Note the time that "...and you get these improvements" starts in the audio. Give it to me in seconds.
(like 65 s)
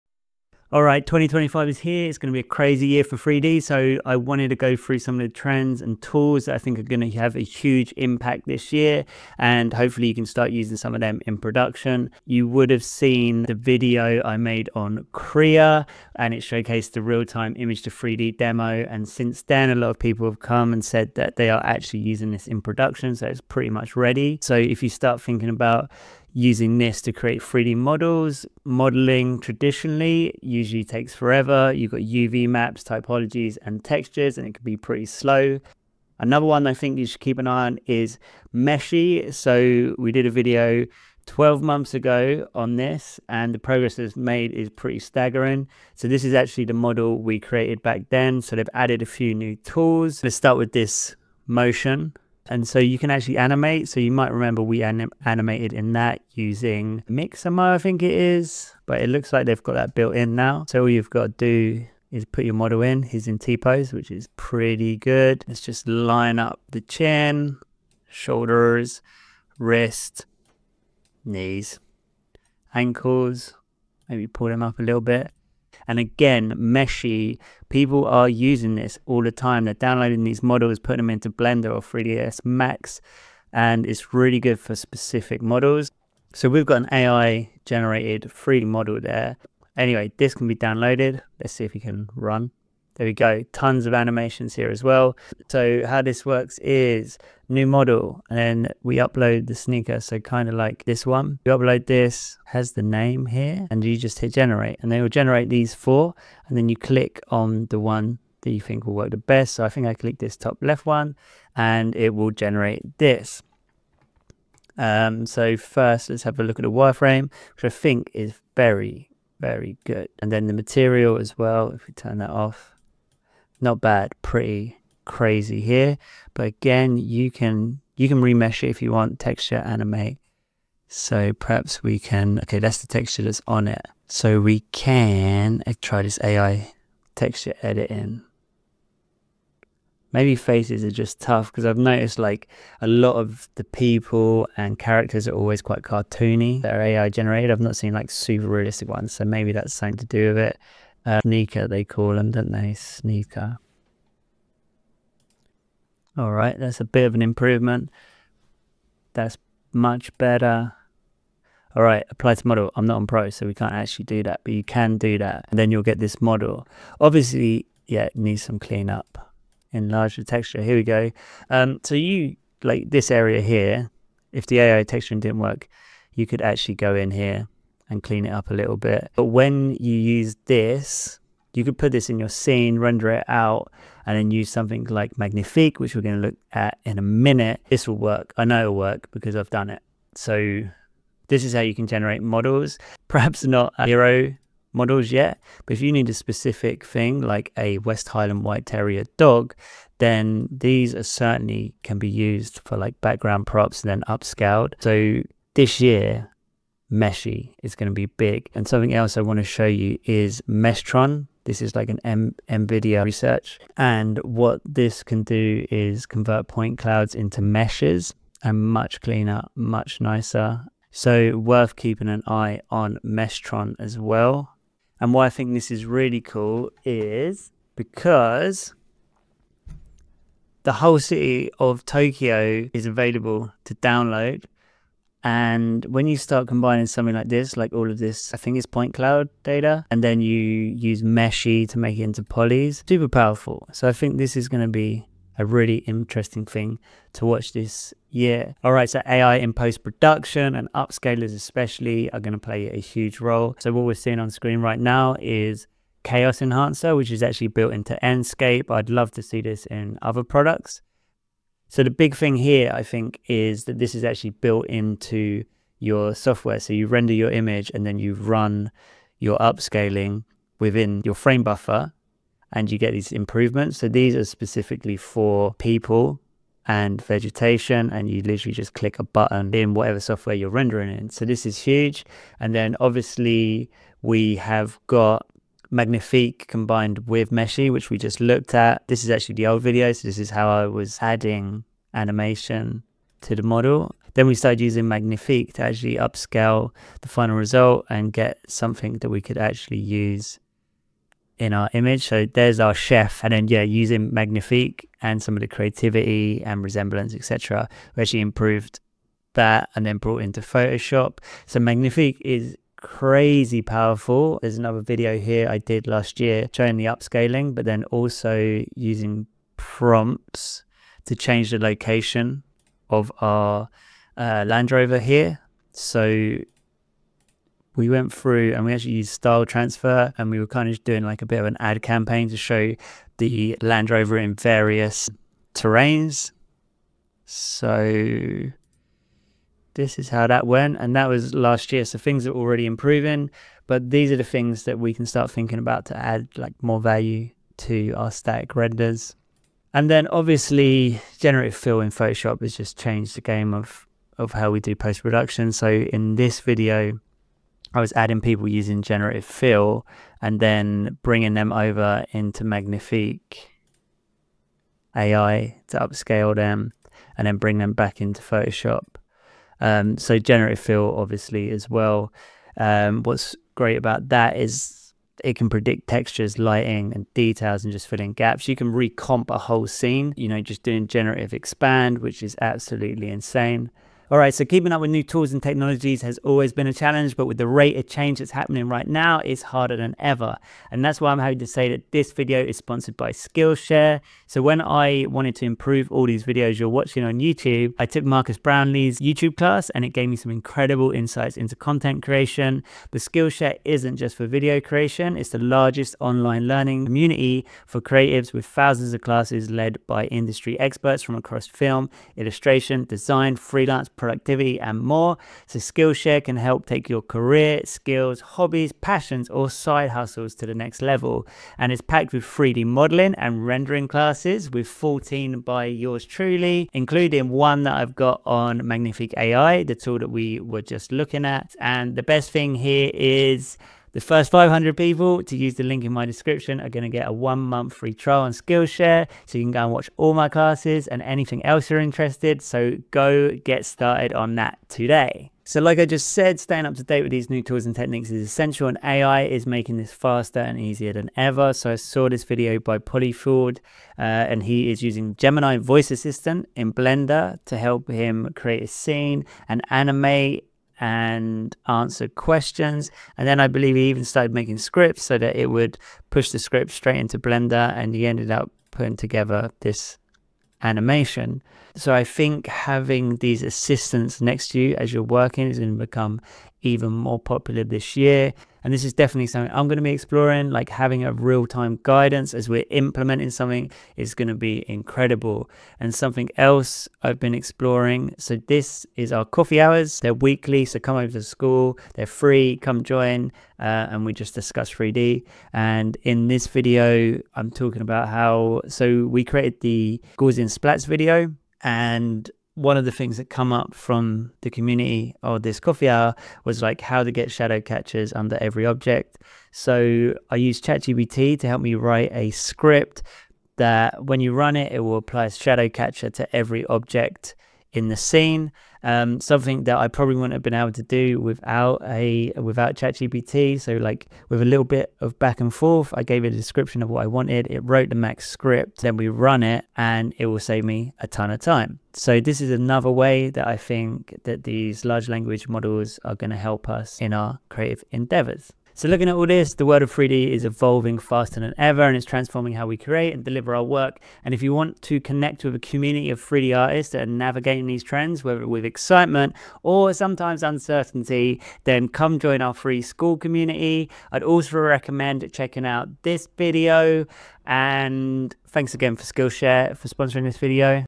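272 s.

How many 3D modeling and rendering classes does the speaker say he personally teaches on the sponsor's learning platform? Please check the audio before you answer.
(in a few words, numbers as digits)
14.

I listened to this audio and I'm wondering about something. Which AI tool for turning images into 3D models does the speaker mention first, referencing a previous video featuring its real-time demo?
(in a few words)
Krea.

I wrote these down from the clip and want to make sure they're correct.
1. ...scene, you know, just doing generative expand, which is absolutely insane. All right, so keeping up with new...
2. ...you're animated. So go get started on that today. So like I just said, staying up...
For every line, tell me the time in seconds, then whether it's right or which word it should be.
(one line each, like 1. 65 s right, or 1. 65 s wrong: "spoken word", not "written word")
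1. 379 s right
2. 441 s wrong: "interested", not "animated".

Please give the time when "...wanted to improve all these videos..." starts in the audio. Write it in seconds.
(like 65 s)
395 s.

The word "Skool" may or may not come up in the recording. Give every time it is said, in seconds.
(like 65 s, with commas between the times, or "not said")
491 s, 552 s.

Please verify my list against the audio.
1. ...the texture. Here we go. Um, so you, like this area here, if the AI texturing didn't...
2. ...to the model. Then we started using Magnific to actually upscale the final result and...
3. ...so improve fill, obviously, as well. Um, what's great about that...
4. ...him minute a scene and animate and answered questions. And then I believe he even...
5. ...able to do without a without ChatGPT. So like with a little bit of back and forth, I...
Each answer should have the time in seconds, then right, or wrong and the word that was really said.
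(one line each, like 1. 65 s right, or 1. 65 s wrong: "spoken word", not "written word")
1. 170 s right
2. 293 s right
3. 369 s wrong: "generative", not "improve"
4. 457 s wrong: "create", not "minute"
5. 520 s right.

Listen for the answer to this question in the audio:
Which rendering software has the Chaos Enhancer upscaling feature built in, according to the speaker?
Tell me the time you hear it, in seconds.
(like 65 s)
258 s.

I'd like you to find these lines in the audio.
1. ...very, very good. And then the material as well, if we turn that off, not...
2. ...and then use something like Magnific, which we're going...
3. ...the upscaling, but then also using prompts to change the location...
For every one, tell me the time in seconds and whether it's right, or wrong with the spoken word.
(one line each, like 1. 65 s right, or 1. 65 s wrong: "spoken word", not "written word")
1. 118 s right
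2. 184 s right
3. 316 s right.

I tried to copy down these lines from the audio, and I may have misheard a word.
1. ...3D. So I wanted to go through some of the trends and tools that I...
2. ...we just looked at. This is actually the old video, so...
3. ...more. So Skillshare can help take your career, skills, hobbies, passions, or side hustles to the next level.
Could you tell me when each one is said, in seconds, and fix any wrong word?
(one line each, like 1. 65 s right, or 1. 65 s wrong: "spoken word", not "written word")
1. 3 s right
2. 287 s right
3. 414 s right.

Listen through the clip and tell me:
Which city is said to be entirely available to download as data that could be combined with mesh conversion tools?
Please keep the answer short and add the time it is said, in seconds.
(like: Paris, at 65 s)
Tokyo, at 231 s.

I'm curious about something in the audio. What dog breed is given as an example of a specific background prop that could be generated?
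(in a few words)
West Highland White Terrier.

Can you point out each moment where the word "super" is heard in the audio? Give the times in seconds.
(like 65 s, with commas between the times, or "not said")
148 s, 242 s.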